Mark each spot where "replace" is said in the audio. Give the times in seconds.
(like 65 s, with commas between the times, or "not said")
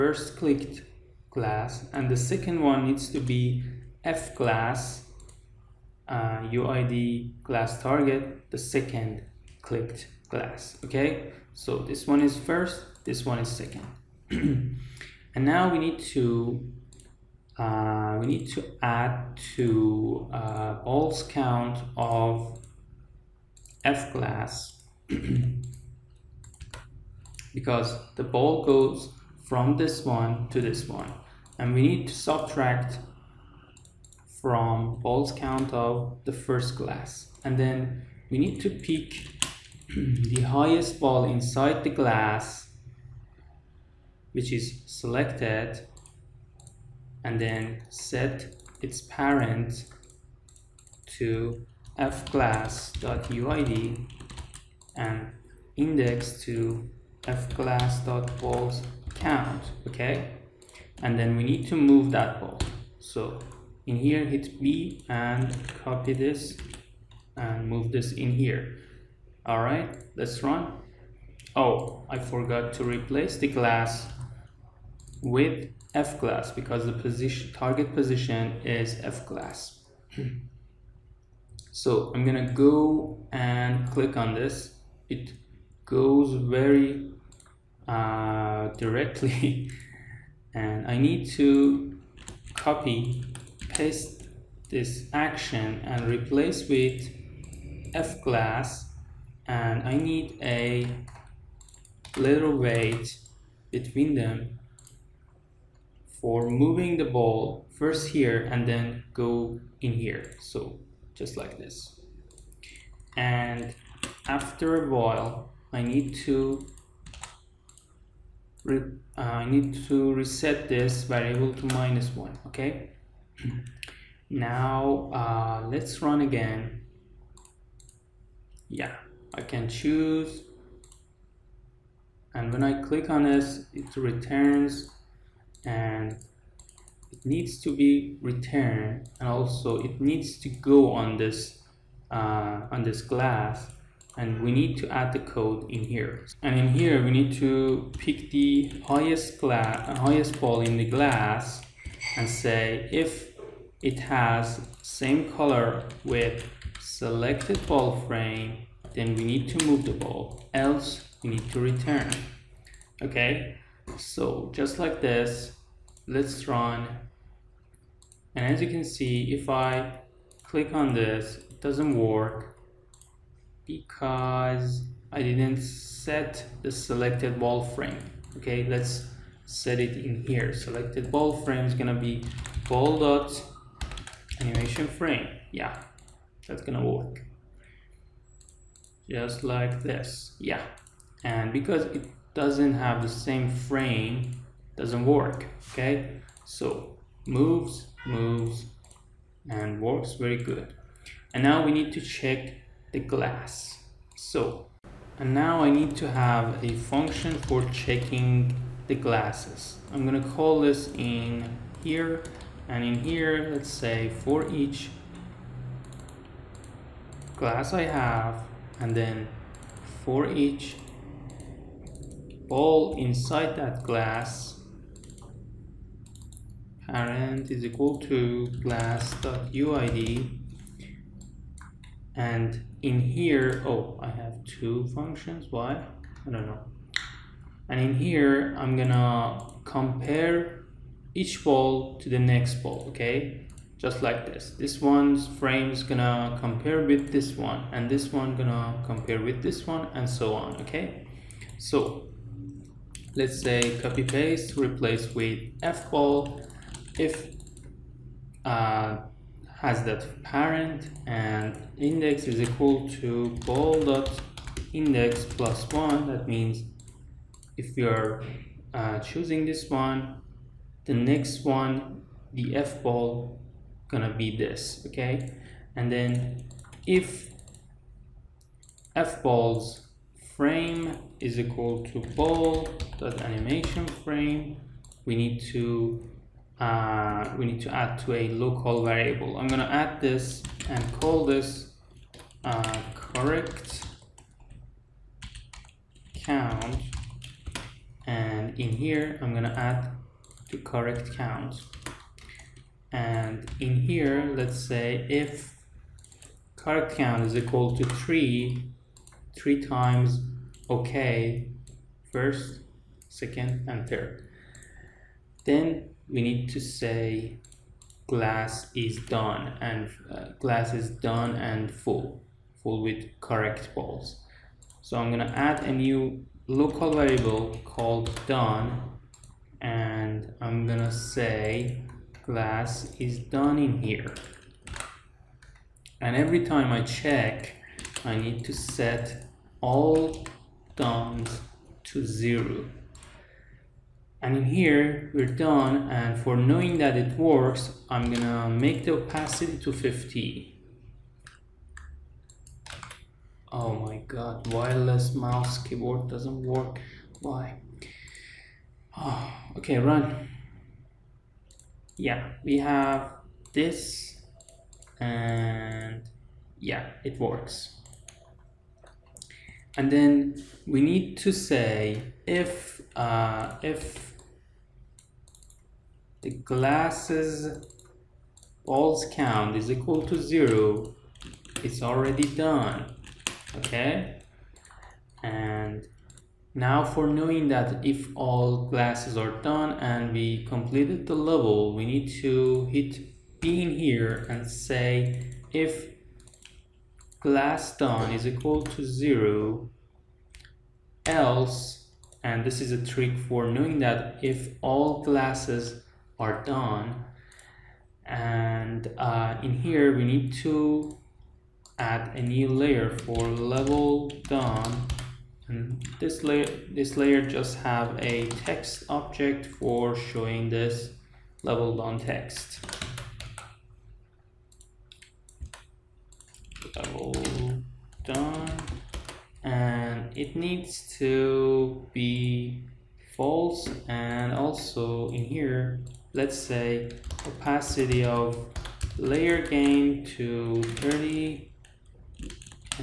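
72 s, 96 s, 254 s.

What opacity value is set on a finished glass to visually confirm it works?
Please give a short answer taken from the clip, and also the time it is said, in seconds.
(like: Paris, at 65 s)
50, at 349 s.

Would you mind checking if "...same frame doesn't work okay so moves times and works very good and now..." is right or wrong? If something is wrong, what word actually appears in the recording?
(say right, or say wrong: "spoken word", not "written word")
wrong: "moves", not "times".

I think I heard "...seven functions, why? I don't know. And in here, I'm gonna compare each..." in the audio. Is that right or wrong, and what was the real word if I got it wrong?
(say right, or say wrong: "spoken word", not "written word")
wrong: "two", not "seven".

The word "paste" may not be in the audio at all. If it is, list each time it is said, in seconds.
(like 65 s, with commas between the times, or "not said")
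93 s, 254 s.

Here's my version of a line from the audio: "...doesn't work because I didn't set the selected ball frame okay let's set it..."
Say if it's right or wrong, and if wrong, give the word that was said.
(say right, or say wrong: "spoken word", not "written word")
right.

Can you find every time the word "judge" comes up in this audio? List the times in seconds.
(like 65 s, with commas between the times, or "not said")
not said.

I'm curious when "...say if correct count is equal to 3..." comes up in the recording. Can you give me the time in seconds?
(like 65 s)
304 s.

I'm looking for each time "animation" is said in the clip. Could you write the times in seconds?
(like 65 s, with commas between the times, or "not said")
184 s, 283 s.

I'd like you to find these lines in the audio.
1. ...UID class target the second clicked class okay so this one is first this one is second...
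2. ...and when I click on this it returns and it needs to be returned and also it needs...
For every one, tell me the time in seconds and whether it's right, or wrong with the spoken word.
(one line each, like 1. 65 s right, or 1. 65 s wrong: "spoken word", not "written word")
1. 6 s right
2. 132 s right.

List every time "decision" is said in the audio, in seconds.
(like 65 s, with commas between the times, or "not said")
not said.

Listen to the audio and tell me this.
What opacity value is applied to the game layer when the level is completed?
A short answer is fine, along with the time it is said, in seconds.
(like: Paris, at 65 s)
30, at 440 s.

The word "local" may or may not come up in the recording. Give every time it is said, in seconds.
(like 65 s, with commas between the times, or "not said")
288 s, 326 s.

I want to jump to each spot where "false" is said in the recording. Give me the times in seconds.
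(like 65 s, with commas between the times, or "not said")
433 s.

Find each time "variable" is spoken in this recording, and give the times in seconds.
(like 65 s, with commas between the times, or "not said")
121 s, 288 s, 326 s.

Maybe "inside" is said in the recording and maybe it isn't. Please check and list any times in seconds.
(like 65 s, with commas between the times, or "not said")
41 s, 222 s.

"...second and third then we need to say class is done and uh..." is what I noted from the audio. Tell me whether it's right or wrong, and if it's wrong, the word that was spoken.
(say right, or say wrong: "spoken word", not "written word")
wrong: "glass", not "class".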